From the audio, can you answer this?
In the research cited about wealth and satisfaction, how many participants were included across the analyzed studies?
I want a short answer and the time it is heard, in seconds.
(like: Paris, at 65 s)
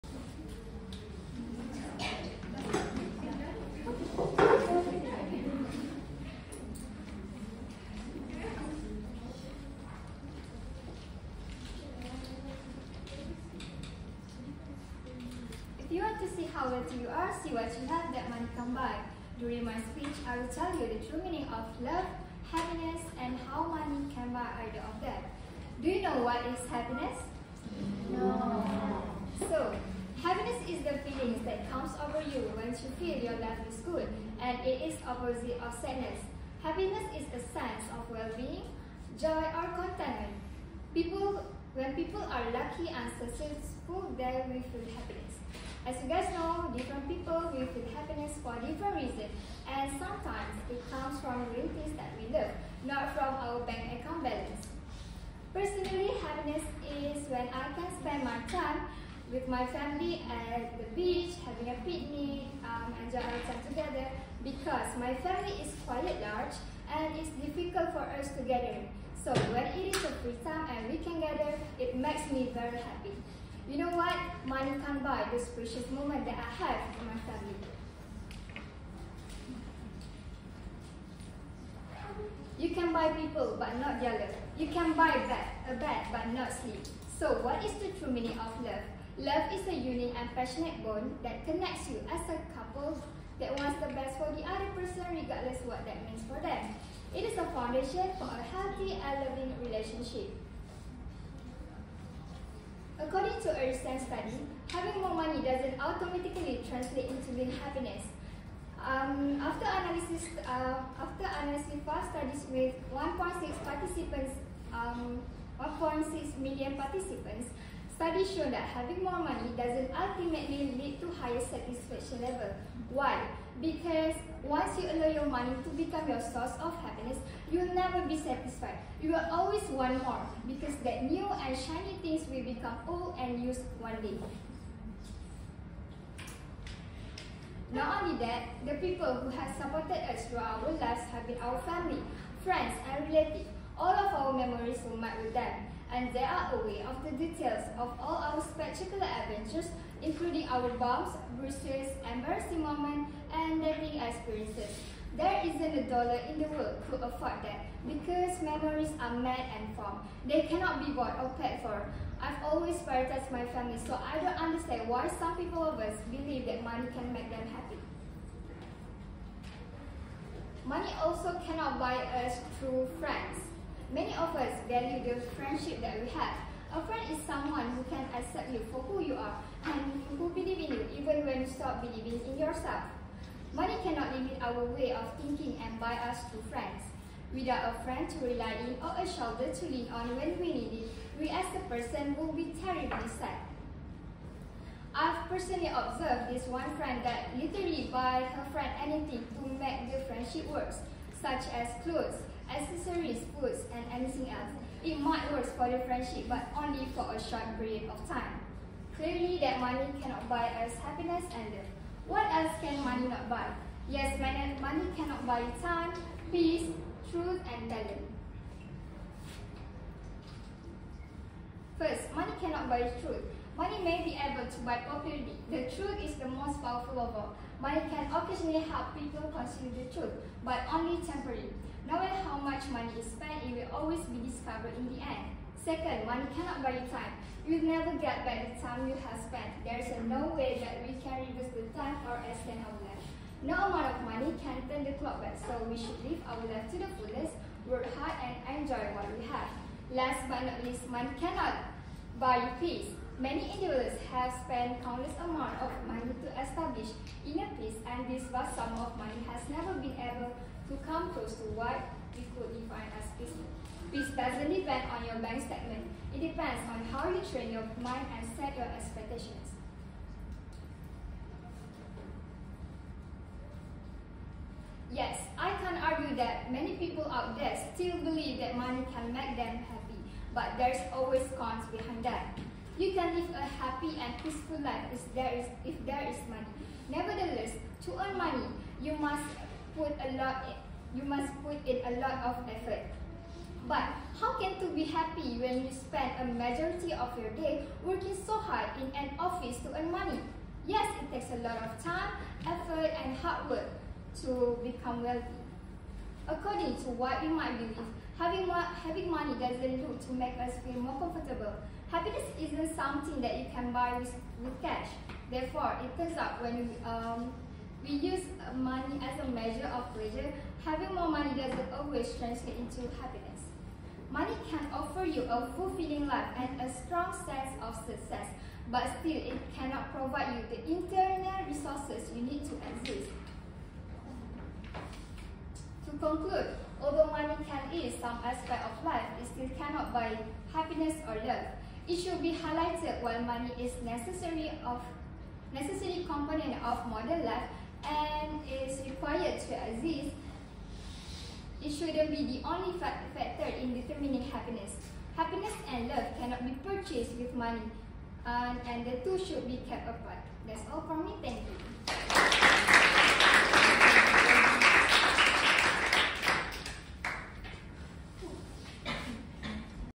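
1.6 million, at 115 s.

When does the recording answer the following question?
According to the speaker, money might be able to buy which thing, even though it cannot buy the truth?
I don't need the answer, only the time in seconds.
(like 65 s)
224 s.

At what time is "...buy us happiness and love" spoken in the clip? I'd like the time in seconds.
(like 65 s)
210 s.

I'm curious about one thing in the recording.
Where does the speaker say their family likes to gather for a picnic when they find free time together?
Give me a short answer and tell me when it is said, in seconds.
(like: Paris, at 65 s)
the beach, at 60 s.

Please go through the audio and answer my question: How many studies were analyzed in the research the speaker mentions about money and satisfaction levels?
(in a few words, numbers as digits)
5.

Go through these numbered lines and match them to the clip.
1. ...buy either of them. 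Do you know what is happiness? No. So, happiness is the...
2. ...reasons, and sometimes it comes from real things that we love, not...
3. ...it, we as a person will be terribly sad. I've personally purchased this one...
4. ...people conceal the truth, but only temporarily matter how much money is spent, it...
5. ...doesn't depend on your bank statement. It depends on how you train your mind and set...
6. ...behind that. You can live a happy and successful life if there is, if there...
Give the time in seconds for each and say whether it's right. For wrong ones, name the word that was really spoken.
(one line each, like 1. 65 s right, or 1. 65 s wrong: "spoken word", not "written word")
1. 24 s right
2. 49 s right
3. 190 s wrong: "observed", not "purchased"
4. 228 s right
5. 264 s right
6. 281 s wrong: "peaceful", not "successful".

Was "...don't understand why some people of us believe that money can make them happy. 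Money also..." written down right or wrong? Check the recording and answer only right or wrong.
right.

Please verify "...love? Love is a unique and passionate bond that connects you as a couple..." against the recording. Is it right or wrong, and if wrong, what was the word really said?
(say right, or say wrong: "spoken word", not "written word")
right.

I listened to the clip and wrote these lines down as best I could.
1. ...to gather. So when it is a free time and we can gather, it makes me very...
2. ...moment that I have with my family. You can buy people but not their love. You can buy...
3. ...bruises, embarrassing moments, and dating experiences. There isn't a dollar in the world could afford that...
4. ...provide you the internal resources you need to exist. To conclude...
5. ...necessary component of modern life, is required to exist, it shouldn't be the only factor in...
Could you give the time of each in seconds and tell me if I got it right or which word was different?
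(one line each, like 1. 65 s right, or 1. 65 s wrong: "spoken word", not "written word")
1. 68 s right
2. 75 s right
3. 151 s right
4. 329 s right
5. 345 s right.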